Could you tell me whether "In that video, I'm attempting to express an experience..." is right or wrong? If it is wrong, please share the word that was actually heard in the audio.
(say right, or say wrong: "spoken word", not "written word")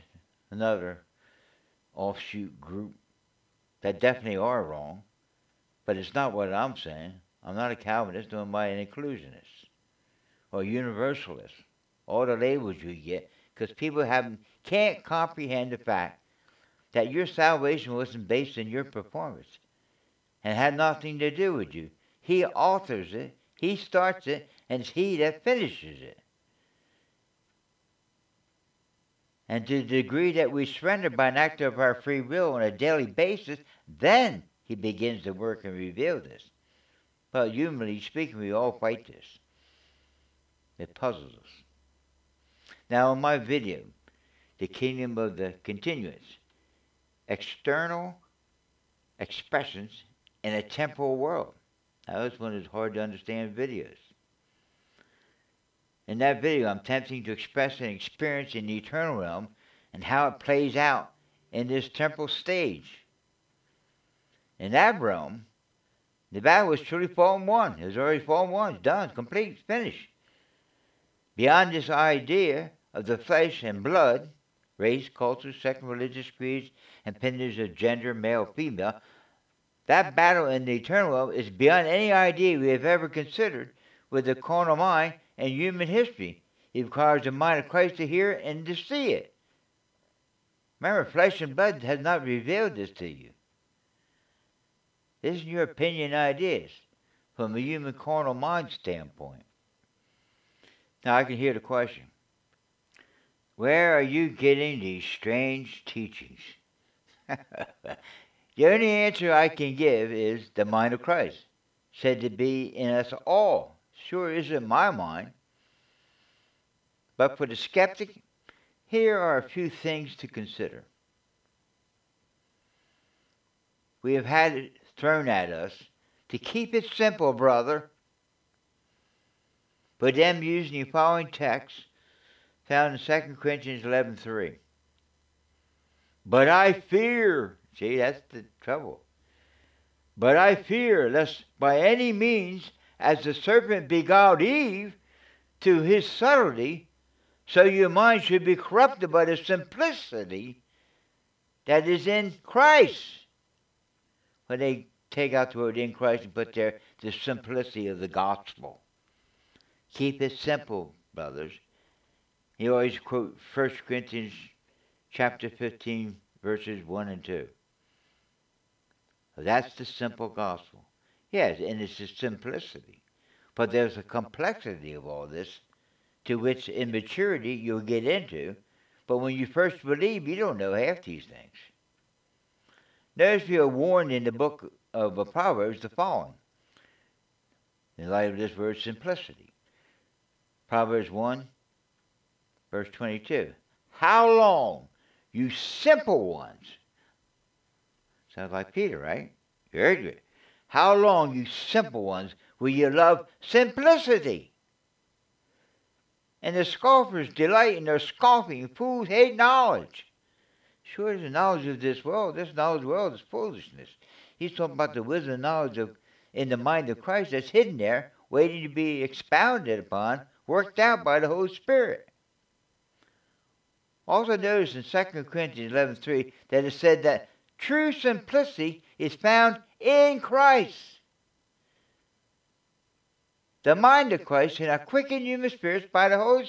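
right.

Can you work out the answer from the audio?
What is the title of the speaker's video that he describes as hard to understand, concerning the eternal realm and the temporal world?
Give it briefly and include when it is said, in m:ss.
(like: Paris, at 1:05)
The Kingdom of the Continuance, at 0:44.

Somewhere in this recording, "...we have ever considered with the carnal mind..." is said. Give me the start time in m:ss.
1:22.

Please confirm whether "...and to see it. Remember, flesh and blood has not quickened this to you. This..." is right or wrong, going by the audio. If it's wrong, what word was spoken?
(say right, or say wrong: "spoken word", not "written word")
wrong: "revealed", not "quickened".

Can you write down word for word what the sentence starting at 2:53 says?
But there's a complexity of all this to which immaturity you'll get into.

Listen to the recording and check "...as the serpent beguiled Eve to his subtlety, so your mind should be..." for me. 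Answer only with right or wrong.
right.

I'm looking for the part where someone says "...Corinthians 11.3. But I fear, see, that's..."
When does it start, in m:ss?
2:13.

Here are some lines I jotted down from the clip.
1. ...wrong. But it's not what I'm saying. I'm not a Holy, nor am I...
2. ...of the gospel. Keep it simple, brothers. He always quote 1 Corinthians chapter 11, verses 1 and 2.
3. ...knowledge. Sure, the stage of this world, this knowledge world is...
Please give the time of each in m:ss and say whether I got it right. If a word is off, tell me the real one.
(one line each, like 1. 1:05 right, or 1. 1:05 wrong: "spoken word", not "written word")
1. 0:04 wrong: "Calvinist", not "Holy"
2. 2:37 wrong: "15", not "11"
3. 3:29 wrong: "knowledge", not "stage".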